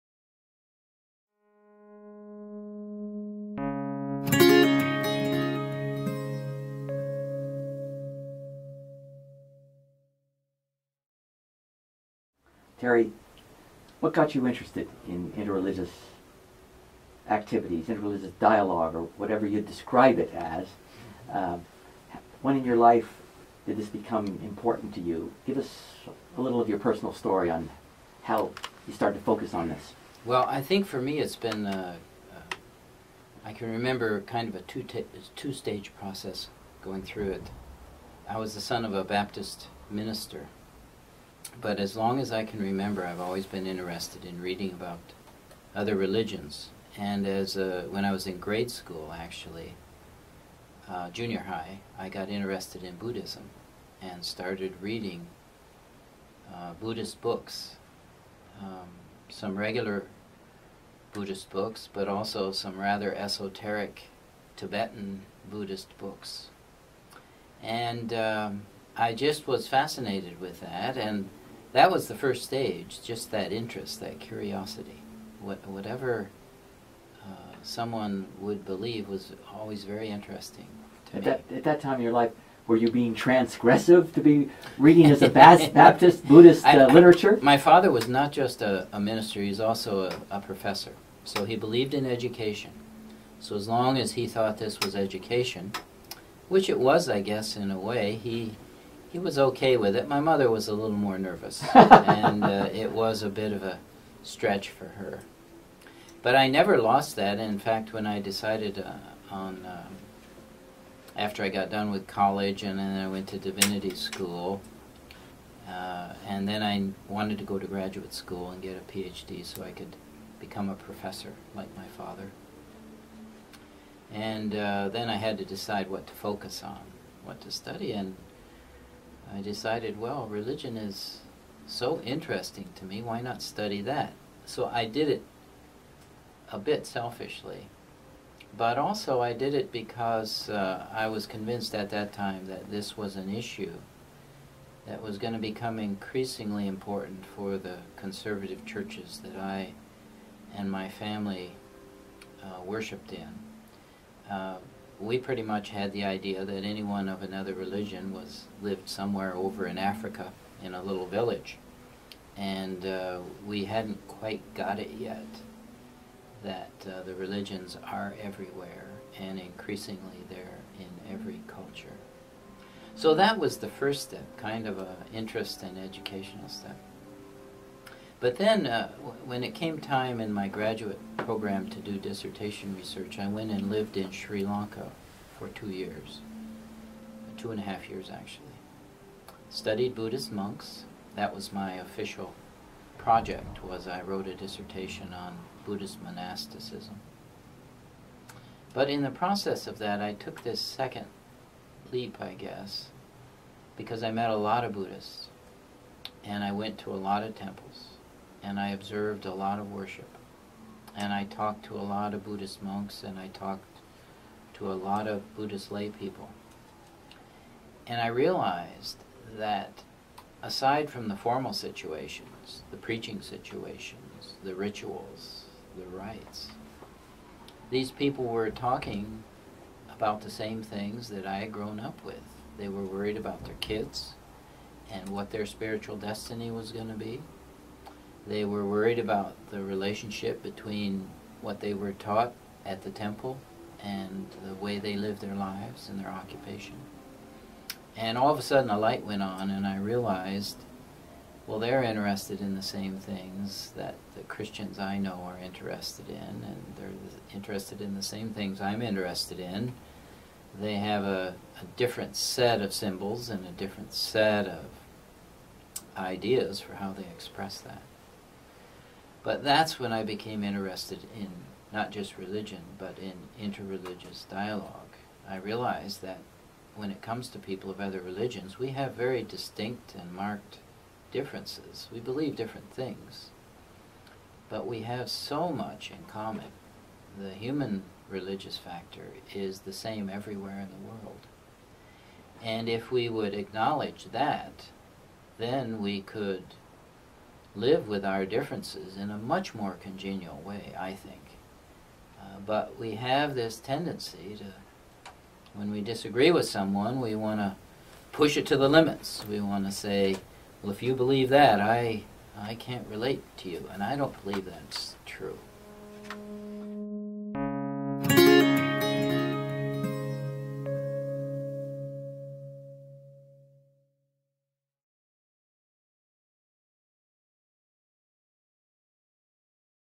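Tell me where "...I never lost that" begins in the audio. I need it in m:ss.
1:46.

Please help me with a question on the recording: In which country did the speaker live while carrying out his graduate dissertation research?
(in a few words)
Sri Lanka.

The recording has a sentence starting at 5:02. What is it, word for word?
Uh, but we have this tendency to, when we disagree with someone, we want to push it to the limits.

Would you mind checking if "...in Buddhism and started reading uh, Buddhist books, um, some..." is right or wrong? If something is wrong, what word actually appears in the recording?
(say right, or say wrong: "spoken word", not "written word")
right.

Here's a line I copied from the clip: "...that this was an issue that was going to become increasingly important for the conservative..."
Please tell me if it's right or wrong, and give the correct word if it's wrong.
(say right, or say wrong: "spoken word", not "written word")
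right.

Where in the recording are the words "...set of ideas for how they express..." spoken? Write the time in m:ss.
4:23.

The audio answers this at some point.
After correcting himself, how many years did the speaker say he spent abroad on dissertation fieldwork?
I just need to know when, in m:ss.
3:07.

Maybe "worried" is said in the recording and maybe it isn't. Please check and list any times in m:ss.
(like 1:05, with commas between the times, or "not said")
3:52, 3:58.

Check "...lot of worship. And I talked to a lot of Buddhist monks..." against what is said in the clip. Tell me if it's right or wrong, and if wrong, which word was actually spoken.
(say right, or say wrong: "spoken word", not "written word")
right.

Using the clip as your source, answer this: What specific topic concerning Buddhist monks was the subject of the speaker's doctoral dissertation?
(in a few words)
Buddhist monasticism.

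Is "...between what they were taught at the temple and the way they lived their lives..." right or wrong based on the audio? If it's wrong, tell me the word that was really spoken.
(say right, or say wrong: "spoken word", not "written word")
right.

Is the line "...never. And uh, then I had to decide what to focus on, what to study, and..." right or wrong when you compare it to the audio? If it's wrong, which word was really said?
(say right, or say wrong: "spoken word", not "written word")
wrong: "father", not "never".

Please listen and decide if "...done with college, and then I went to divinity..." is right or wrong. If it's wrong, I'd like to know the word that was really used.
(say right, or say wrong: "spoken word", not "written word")
right.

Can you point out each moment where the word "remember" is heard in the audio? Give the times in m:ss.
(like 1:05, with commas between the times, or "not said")
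0:33, 0:42.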